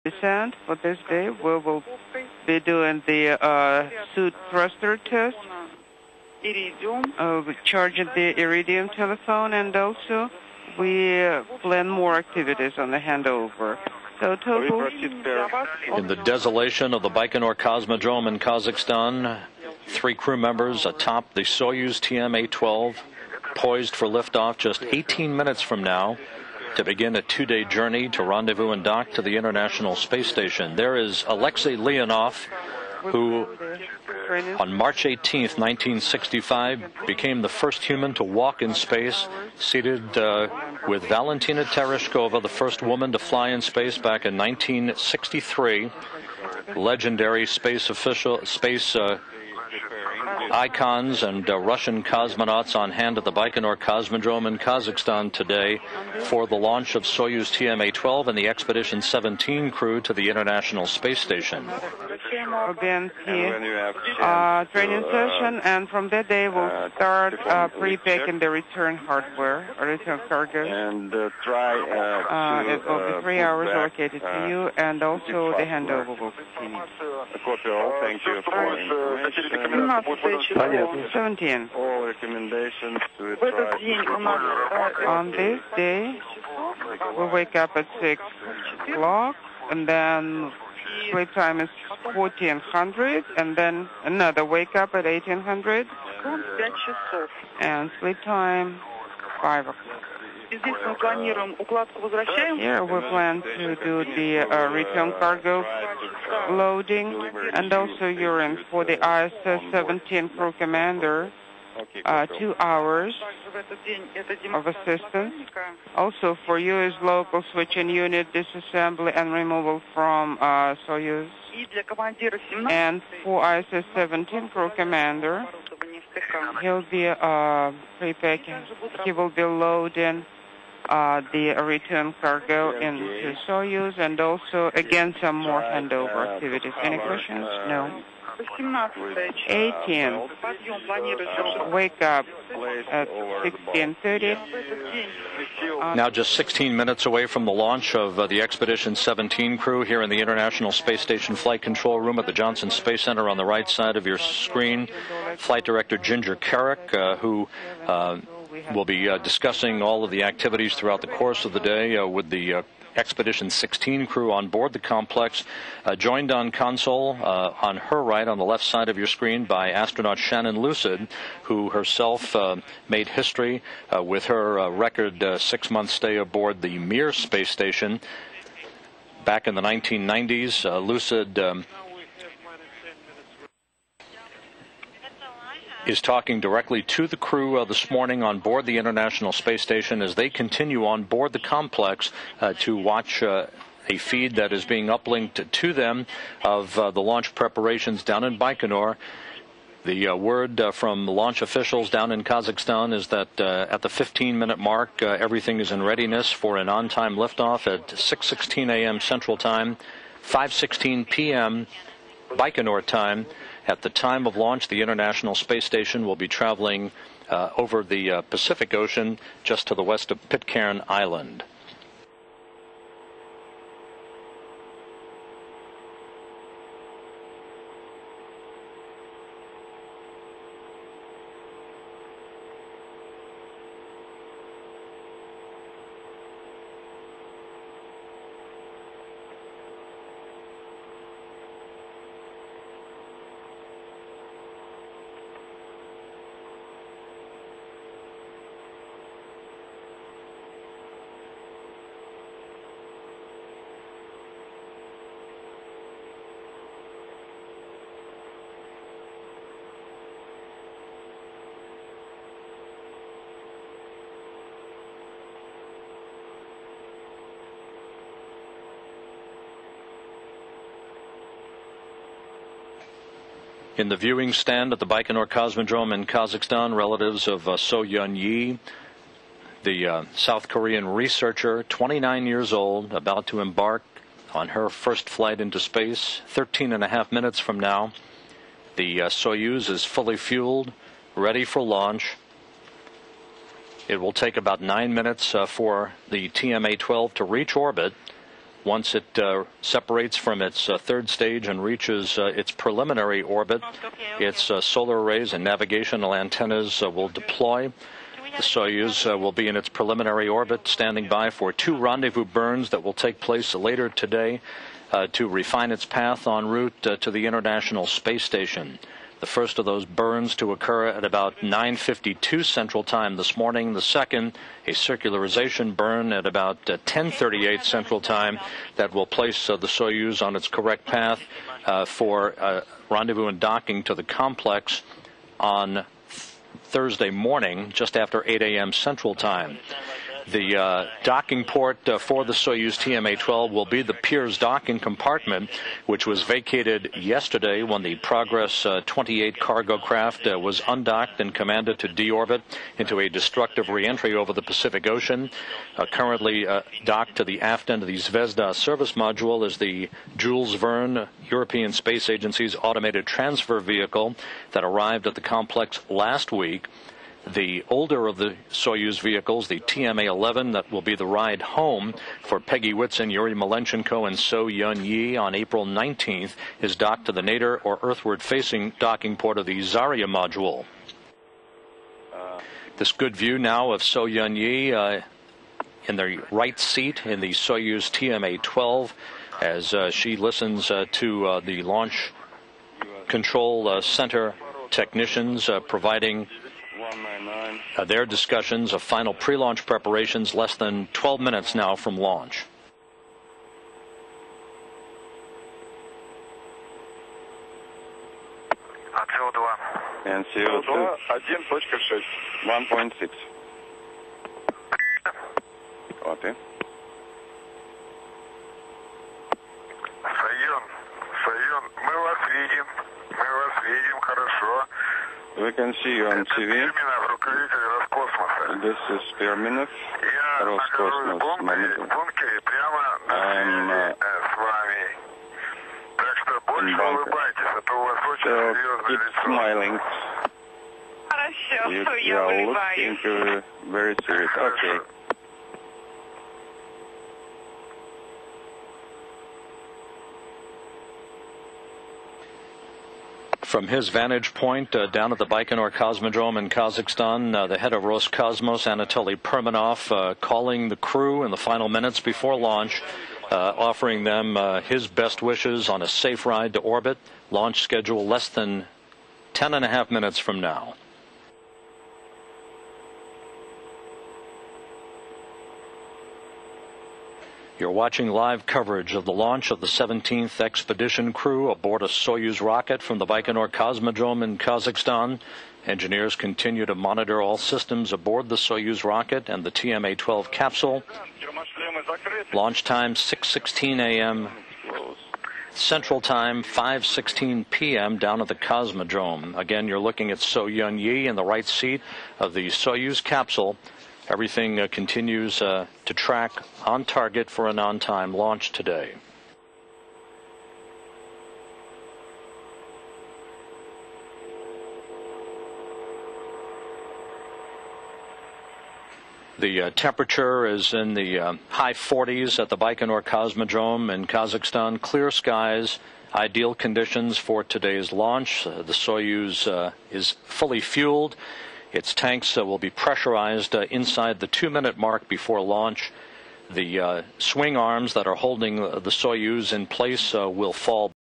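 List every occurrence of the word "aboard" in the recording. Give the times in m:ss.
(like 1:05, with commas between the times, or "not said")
2:56, 8:01, 8:07.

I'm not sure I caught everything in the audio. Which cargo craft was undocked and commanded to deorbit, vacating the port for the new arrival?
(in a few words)
Progress 28.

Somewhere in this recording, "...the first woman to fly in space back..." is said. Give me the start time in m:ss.
0:42.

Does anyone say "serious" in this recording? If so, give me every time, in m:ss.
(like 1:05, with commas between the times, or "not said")
7:24.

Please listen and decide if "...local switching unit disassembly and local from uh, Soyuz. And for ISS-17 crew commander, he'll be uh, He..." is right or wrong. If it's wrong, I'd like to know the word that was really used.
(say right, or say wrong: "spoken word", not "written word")
wrong: "removal", not "local".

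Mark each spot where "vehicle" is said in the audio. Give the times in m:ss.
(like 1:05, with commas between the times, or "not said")
6:03, 6:08.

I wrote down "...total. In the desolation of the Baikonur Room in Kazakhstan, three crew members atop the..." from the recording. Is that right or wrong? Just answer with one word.
wrong.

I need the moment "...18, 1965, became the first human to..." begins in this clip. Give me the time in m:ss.
0:35.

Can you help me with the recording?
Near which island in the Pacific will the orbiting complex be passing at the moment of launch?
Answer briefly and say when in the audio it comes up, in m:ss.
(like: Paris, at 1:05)
Pitcairn Island, at 3:40.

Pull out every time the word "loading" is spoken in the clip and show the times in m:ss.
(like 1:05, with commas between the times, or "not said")
1:46, 2:09.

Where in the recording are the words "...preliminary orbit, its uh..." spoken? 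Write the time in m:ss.
5:02.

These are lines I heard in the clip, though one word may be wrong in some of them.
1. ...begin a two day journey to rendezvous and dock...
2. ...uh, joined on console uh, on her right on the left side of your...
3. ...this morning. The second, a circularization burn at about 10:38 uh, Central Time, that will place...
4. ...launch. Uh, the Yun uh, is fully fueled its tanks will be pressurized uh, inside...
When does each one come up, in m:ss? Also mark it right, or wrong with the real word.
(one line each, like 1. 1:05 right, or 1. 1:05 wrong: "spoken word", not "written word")
1. 0:26 right
2. 2:45 right
3. 5:23 right
4. 8:47 wrong: "Soyuz", not "Yun".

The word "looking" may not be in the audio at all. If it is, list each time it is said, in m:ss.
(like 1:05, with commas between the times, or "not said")
7:22, 8:19.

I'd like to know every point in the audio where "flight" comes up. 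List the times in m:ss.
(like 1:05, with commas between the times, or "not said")
2:31, 2:35, 4:45.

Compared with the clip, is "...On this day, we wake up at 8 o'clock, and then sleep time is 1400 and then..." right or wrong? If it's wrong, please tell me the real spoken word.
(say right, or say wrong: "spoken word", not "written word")
wrong: "6", not "8".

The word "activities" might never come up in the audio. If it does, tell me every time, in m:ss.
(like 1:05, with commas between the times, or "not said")
0:12, 2:16, 2:40.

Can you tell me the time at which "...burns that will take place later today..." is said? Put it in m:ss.
5:12.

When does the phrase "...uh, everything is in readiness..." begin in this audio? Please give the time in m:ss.
3:25.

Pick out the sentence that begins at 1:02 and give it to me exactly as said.
DNC uh, uh, training session, and from that day we'll uh, start uh, pre-packing the return hardware, return cargo.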